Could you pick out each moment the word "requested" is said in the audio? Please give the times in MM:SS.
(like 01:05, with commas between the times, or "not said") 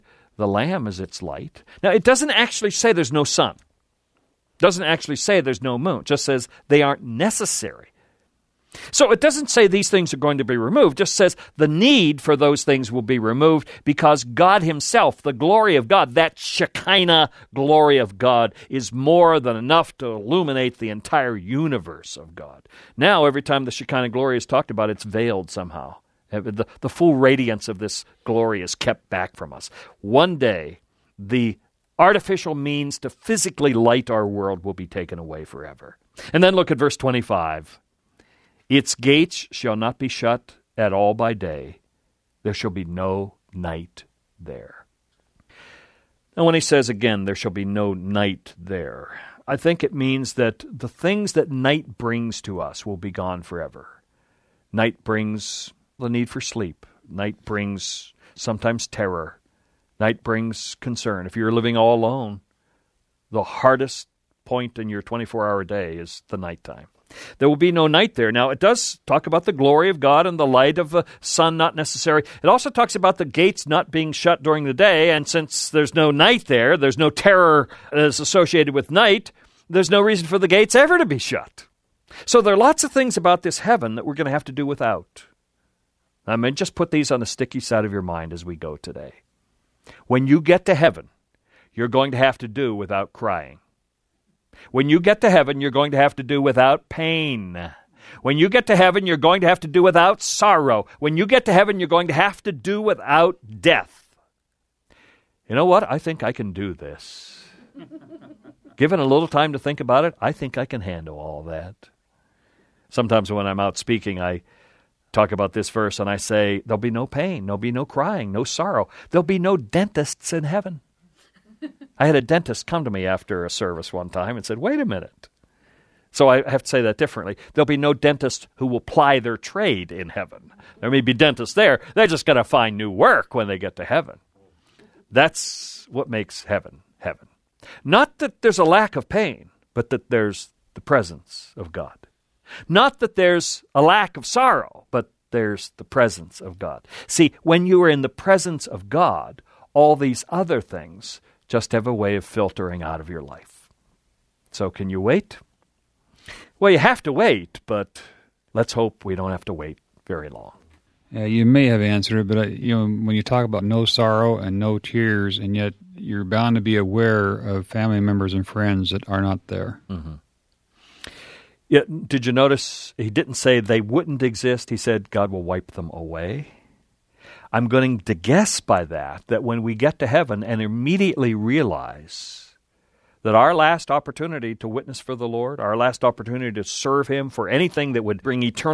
not said.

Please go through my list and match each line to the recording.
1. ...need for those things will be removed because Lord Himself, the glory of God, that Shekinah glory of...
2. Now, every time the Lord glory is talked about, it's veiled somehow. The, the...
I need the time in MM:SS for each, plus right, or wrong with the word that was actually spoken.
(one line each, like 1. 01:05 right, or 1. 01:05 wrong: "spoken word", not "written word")
1. 00:11 wrong: "God", not "Lord"
2. 00:22 wrong: "Shekinah", not "Lord".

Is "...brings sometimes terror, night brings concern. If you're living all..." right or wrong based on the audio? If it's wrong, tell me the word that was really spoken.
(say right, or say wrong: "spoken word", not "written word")
right.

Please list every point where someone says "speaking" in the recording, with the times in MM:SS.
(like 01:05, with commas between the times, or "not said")
01:53.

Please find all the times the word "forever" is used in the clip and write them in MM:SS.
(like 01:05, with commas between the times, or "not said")
00:35, 00:53.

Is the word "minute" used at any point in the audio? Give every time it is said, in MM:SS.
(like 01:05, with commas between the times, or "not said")
02:04.